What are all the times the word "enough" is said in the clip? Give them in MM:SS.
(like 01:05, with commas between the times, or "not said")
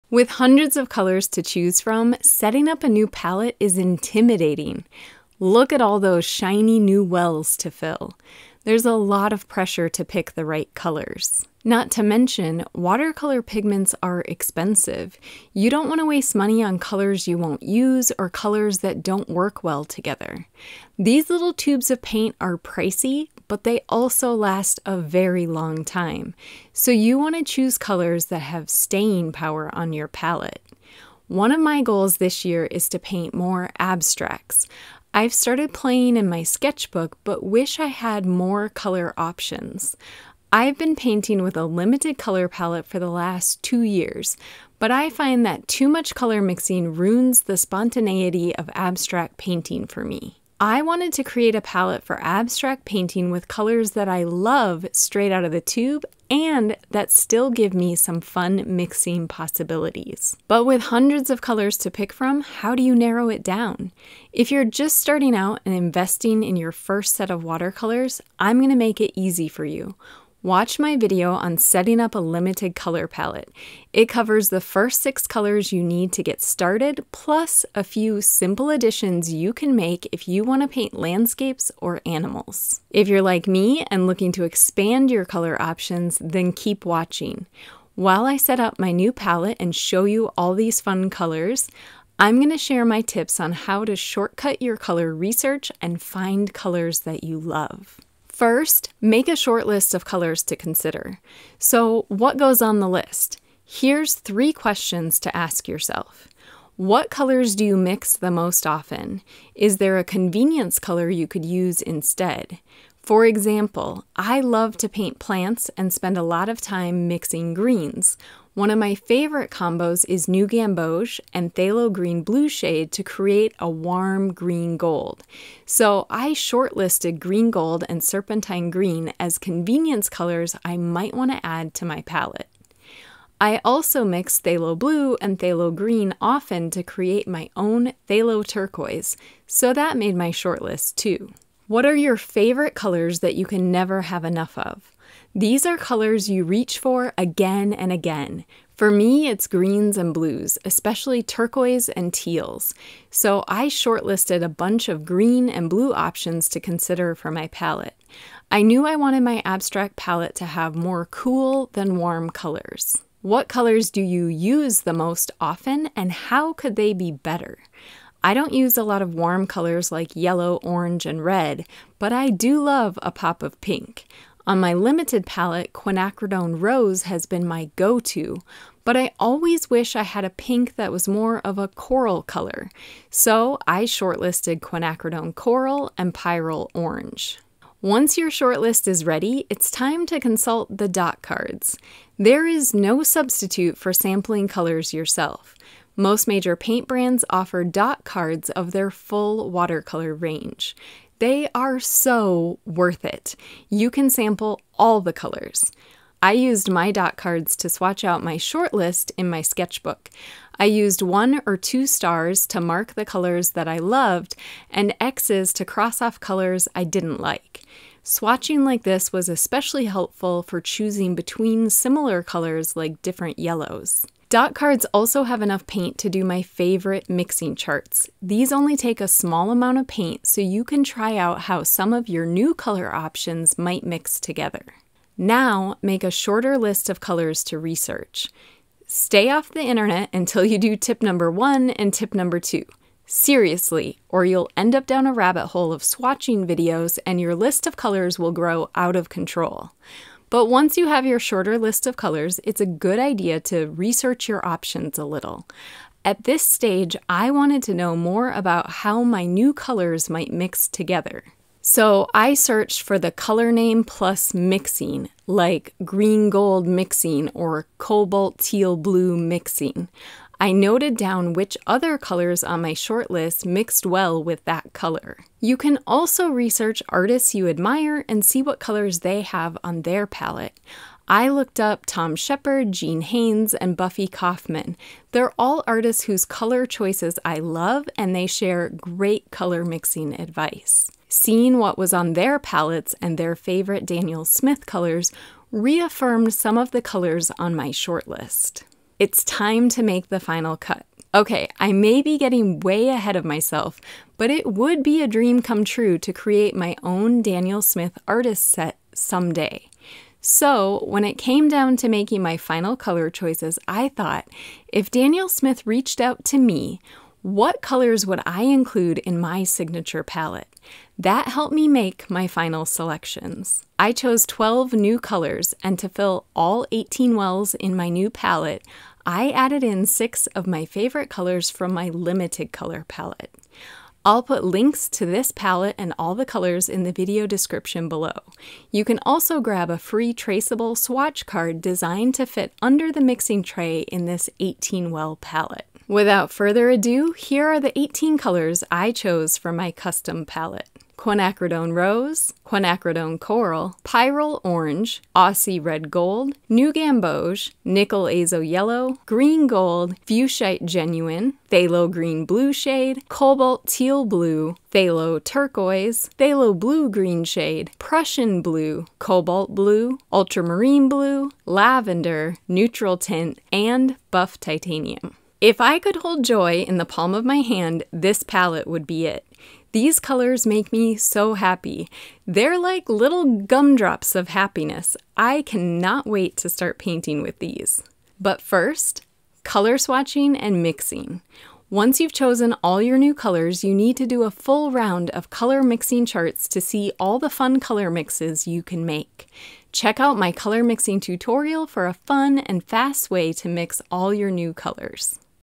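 02:24, 03:45.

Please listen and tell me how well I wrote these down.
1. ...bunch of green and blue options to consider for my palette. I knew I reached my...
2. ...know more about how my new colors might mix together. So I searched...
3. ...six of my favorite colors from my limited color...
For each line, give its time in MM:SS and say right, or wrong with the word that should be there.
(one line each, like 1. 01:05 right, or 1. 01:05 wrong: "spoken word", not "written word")
1. 02:34 wrong: "wanted", not "reached"
2. 04:17 right
3. 05:29 right.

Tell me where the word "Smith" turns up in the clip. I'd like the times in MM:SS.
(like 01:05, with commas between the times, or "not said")
04:54, 05:07, 05:15.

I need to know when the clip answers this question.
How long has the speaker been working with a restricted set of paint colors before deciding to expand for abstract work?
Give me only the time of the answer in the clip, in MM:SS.
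00:43.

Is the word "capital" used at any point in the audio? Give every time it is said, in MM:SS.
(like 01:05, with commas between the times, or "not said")
not said.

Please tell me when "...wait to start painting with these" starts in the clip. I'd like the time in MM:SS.
06:26.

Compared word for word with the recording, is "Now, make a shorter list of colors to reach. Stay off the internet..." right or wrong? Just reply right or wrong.
wrong.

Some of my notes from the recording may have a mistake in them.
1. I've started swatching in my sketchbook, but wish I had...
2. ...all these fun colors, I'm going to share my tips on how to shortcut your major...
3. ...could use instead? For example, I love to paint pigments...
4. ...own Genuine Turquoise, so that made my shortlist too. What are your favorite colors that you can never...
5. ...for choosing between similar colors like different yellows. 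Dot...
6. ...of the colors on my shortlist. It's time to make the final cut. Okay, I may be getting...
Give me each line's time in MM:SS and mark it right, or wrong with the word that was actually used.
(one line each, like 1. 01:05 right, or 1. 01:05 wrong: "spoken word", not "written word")
1. 00:35 wrong: "playing", not "swatching"
2. 01:30 wrong: "color", not "major"
3. 01:51 wrong: "plants", not "pigments"
4. 02:17 wrong: "Phthalo", not "Genuine"
5. 03:40 right
6. 04:56 right.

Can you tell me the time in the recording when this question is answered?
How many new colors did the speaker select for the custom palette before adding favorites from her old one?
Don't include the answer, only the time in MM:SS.
05:24.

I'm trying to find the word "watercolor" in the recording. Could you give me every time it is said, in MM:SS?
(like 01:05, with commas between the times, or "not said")
00:12, 01:07, 03:19.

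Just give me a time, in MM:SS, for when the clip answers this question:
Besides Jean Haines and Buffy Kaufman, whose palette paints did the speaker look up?
04:41.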